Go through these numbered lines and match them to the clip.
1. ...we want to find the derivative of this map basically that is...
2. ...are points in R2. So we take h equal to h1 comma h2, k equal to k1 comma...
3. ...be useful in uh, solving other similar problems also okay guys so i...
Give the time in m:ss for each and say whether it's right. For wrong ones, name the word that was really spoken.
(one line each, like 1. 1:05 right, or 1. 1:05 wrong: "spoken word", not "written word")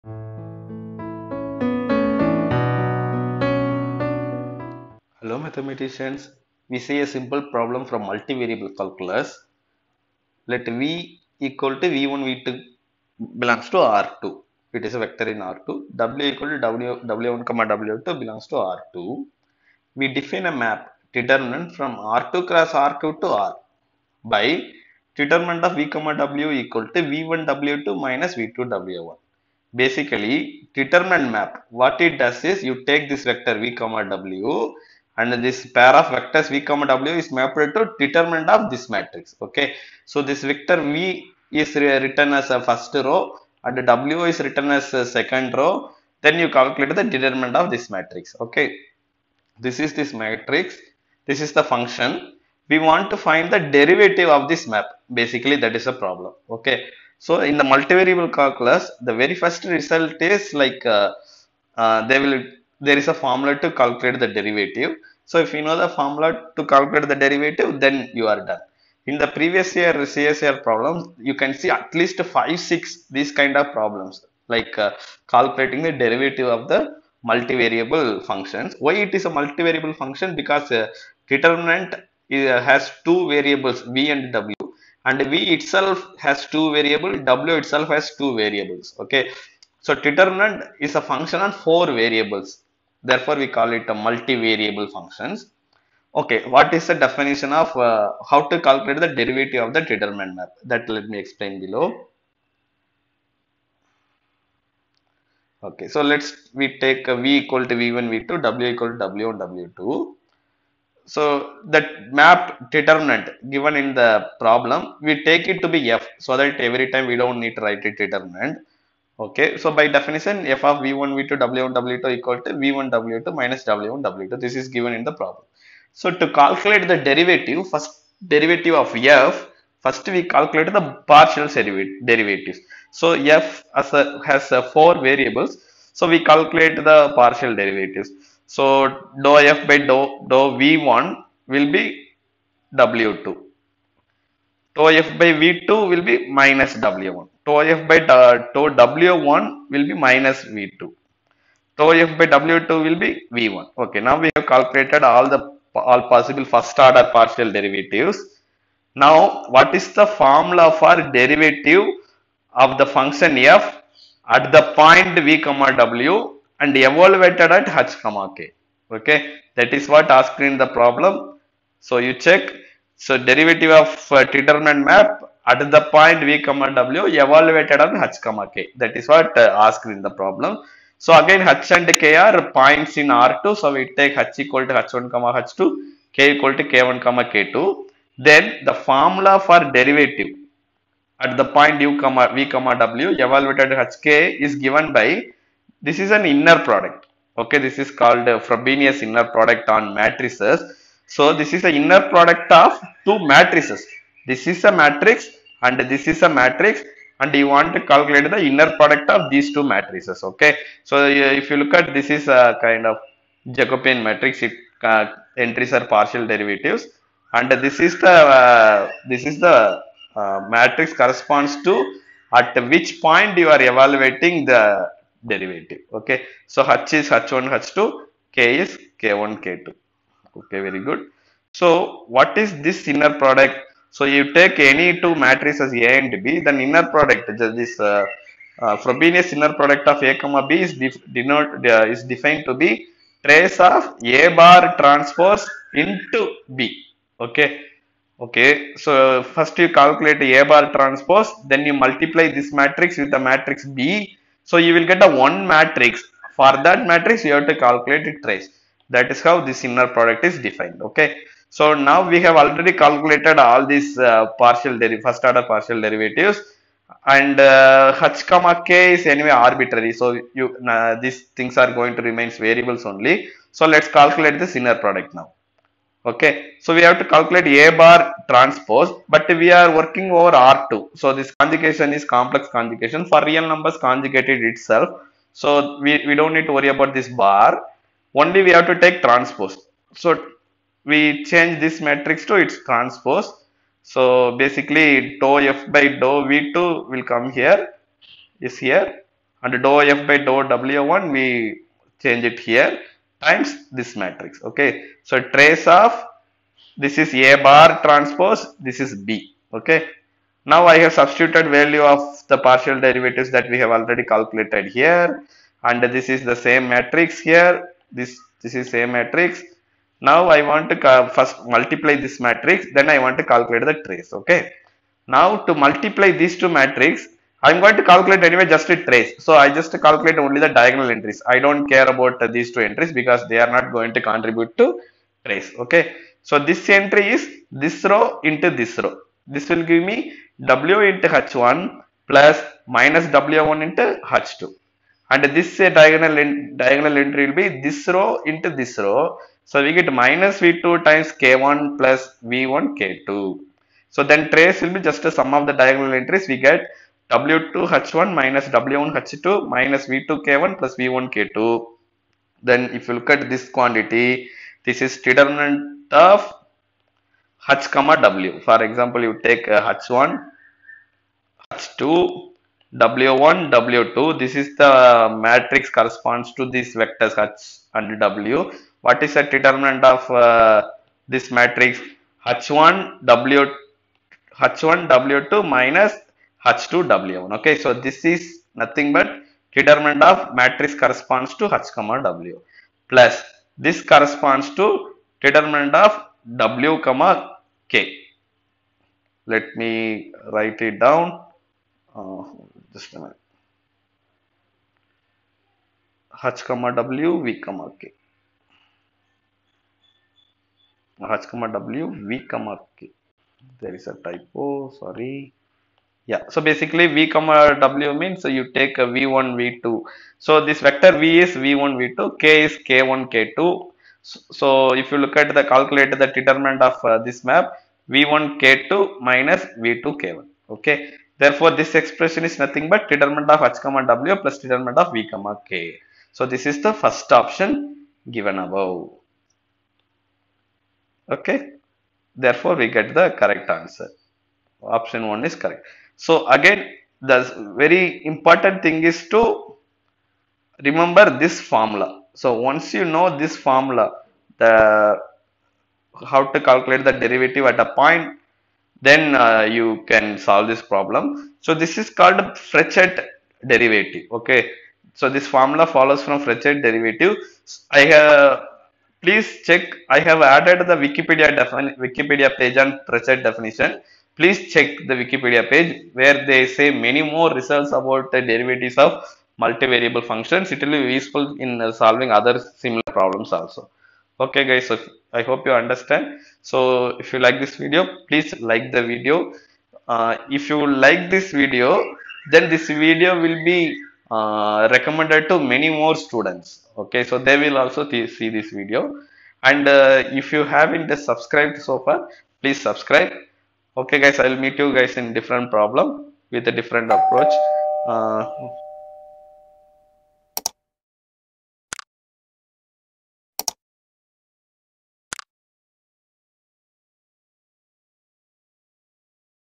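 1. 0:52 right
2. 3:02 right
3. 8:00 right.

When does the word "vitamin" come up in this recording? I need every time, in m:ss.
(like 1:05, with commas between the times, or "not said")
not said.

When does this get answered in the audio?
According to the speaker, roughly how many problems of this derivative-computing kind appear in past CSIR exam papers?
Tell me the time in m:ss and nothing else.
1:12.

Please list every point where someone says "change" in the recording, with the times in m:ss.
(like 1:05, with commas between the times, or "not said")
4:51, 5:02.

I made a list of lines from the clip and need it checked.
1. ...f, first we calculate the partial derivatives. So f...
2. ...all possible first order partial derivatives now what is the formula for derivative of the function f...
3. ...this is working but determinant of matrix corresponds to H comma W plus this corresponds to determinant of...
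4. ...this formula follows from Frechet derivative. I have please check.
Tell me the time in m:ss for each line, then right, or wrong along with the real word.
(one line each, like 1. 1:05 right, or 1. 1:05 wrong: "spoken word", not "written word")
1. 2:08 right
2. 2:35 right
3. 6:27 wrong: "nothing", not "working"
4. 7:45 right.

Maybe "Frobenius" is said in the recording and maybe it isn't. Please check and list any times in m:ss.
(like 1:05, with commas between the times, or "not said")
3:18, 3:58.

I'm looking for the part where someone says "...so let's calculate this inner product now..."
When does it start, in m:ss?
4:33.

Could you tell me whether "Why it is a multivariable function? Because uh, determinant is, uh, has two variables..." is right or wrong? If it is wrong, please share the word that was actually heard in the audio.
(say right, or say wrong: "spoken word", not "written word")
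right.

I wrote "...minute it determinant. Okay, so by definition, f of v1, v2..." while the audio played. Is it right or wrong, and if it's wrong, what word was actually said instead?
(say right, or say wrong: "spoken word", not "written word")
wrong: "write", not "minute".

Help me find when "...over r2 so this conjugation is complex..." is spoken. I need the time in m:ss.
4:40.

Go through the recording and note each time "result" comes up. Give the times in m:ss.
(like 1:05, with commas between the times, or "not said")
0:59, 7:57.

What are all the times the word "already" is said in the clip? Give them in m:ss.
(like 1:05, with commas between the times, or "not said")
4:22, 5:13.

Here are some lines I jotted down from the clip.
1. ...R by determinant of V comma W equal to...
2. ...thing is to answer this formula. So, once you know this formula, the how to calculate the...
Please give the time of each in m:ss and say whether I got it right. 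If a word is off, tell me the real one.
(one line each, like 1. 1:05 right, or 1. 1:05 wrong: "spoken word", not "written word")
1. 0:23 right
2. 7:28 wrong: "remember", not "answer".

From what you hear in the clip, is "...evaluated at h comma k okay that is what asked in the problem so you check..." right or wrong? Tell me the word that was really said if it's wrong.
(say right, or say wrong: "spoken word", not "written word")
right.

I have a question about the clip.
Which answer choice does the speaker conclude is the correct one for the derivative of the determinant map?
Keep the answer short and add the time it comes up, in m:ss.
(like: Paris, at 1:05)
Option 1, at 7:24.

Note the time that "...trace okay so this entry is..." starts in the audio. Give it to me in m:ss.
5:35.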